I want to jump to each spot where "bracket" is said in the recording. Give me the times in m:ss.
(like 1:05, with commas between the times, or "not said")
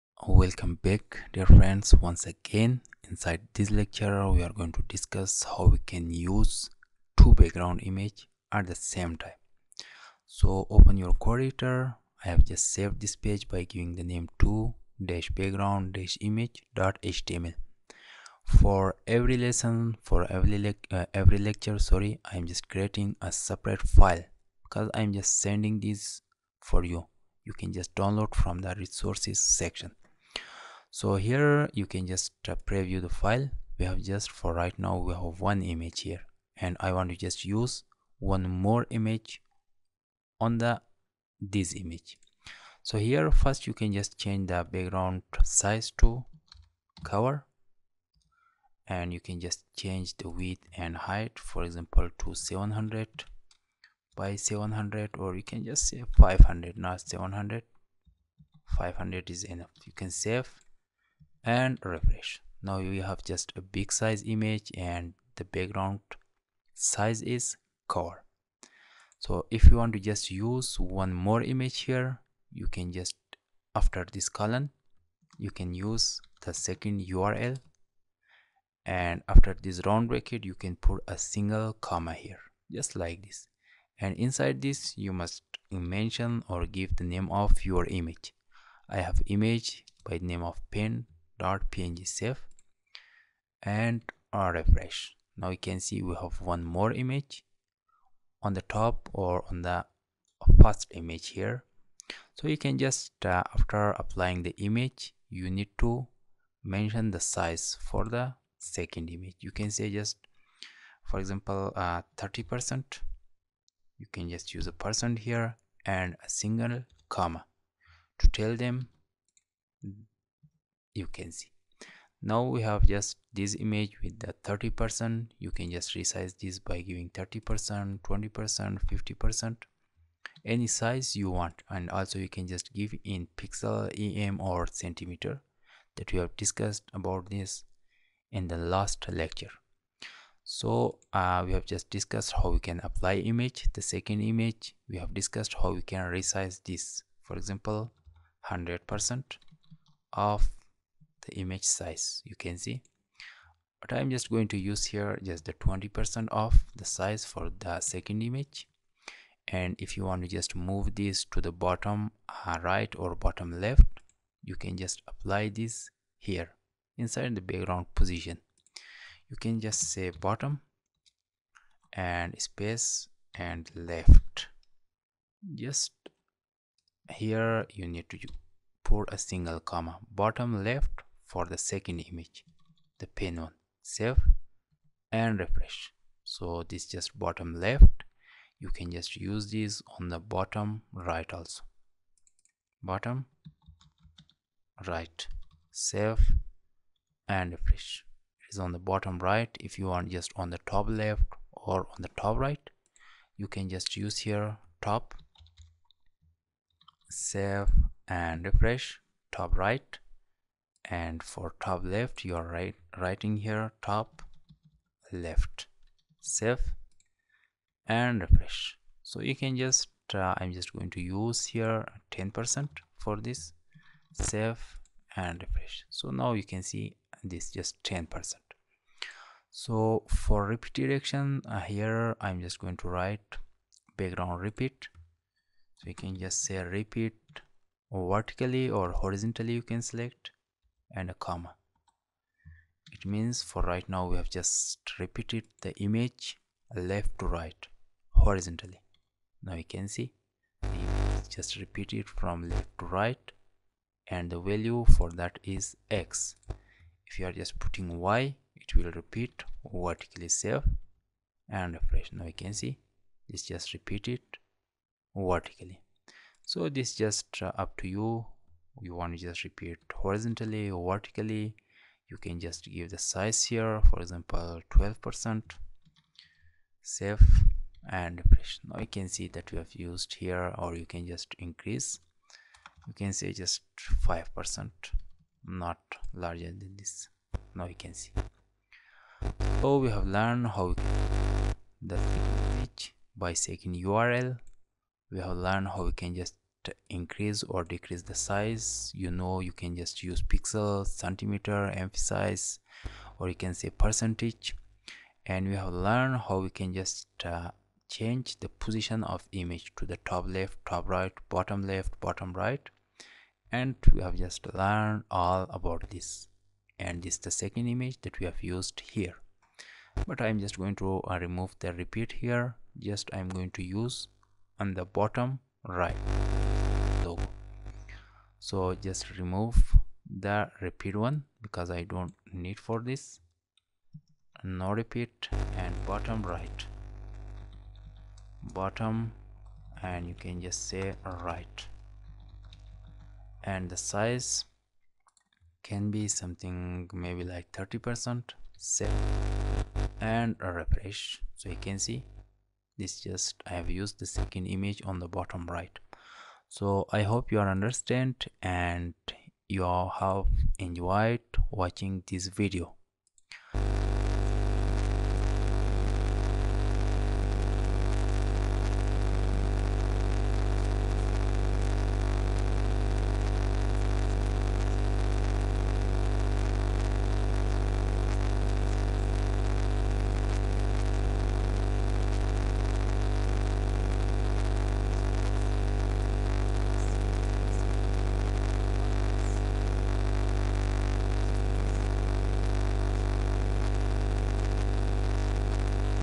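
1:20.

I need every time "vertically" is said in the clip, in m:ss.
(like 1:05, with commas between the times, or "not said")
3:57, 4:19, 4:25, 4:30.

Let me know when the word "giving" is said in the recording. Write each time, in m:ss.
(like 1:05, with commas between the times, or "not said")
0:13, 2:06.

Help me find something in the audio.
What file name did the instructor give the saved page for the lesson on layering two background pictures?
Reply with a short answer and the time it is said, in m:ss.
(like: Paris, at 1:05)
2-background-image.html, at 0:14.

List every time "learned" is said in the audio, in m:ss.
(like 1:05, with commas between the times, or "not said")
4:50, 4:55, 5:05, 5:14.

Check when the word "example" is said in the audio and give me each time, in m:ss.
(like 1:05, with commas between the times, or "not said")
0:51, 1:51, 2:27, 4:34.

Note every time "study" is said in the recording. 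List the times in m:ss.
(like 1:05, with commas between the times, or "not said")
not said.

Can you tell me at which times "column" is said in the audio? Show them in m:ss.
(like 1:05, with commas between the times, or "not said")
1:14.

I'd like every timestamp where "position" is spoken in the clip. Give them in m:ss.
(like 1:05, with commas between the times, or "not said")
2:47, 5:08.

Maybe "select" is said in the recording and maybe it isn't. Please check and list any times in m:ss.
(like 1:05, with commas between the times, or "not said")
3:59.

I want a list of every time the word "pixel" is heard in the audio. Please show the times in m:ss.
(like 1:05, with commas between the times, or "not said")
2:13, 5:00.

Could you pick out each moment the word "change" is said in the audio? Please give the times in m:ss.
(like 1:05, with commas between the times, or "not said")
0:44, 0:49, 5:07.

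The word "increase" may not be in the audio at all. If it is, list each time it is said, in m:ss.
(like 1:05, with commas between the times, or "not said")
4:41, 4:56.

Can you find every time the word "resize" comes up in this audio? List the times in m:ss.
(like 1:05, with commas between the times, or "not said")
2:05, 2:26.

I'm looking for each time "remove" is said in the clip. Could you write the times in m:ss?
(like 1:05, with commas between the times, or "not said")
5:21, 5:29.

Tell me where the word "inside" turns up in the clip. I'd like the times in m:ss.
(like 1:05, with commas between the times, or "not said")
0:03, 1:24, 2:46.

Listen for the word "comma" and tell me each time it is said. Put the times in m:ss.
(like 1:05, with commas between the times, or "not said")
1:21, 1:57, 2:59, 4:01.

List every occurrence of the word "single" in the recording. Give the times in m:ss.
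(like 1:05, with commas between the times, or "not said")
1:21, 1:56, 2:59.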